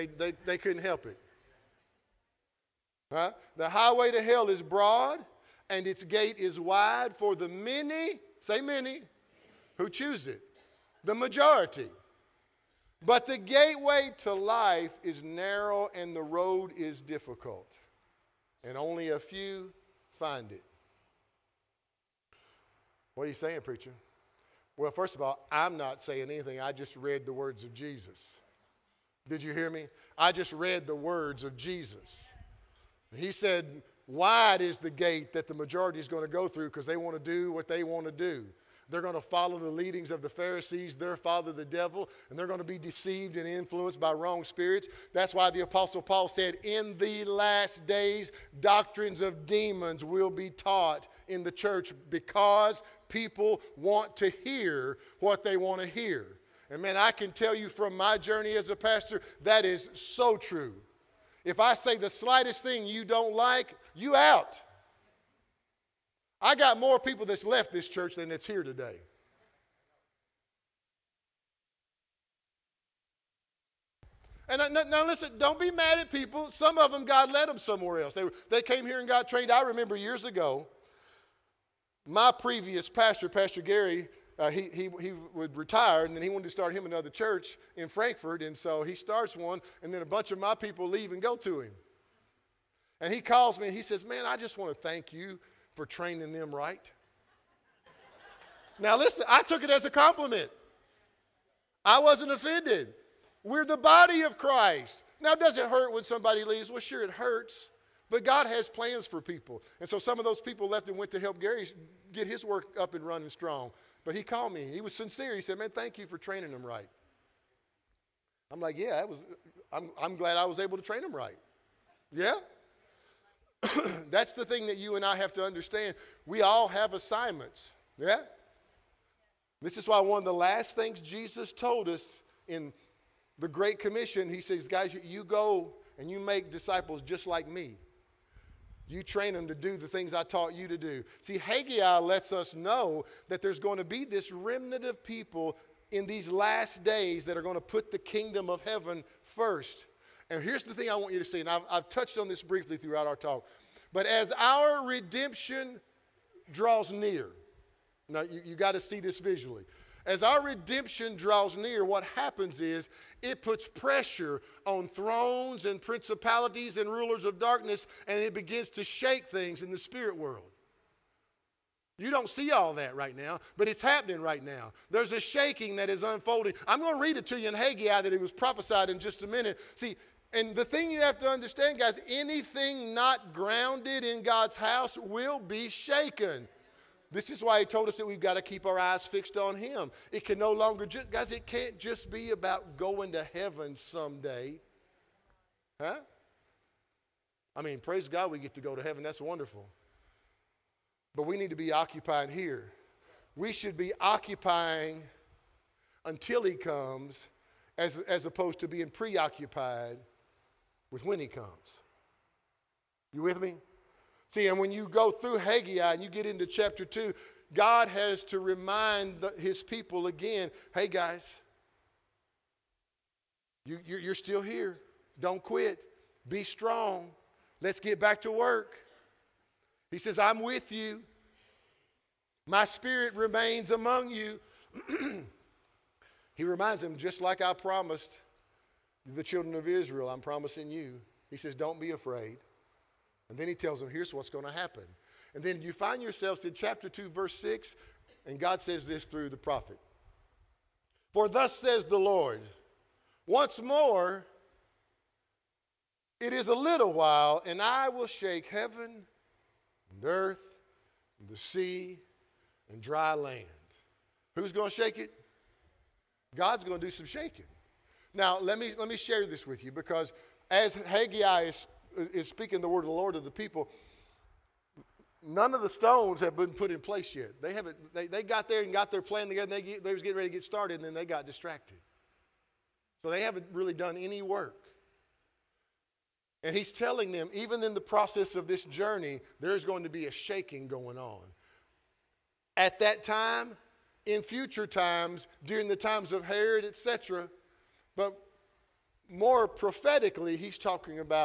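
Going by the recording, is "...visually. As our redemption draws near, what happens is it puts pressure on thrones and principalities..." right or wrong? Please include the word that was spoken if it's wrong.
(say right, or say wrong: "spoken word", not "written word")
right.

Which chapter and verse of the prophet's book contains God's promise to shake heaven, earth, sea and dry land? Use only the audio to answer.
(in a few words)
Chapter 2, verse 6.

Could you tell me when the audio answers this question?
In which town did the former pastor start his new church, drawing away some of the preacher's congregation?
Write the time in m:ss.
1:27.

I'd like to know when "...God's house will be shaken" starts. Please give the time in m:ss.
3:04.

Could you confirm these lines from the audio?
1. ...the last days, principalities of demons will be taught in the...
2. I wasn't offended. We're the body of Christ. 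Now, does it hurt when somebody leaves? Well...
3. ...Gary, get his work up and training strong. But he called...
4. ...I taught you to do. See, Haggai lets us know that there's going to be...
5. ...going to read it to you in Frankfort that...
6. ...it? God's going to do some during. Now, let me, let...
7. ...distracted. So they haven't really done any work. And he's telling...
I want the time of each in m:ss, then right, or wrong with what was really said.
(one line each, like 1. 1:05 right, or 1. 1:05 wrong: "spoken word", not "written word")
1. 0:46 wrong: "doctrines", not "principalities"
2. 1:41 right
3. 1:51 wrong: "running", not "training"
4. 2:20 right
5. 2:56 wrong: "Haggai", not "Frankfort"
6. 4:24 wrong: "shaking", not "during"
7. 4:41 right.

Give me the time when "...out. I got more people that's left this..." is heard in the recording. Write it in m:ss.
1:04.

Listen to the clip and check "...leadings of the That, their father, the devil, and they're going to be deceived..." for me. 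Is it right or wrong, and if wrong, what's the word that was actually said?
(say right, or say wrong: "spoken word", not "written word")
wrong: "Pharisees", not "That".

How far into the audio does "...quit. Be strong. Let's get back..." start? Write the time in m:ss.
3:45.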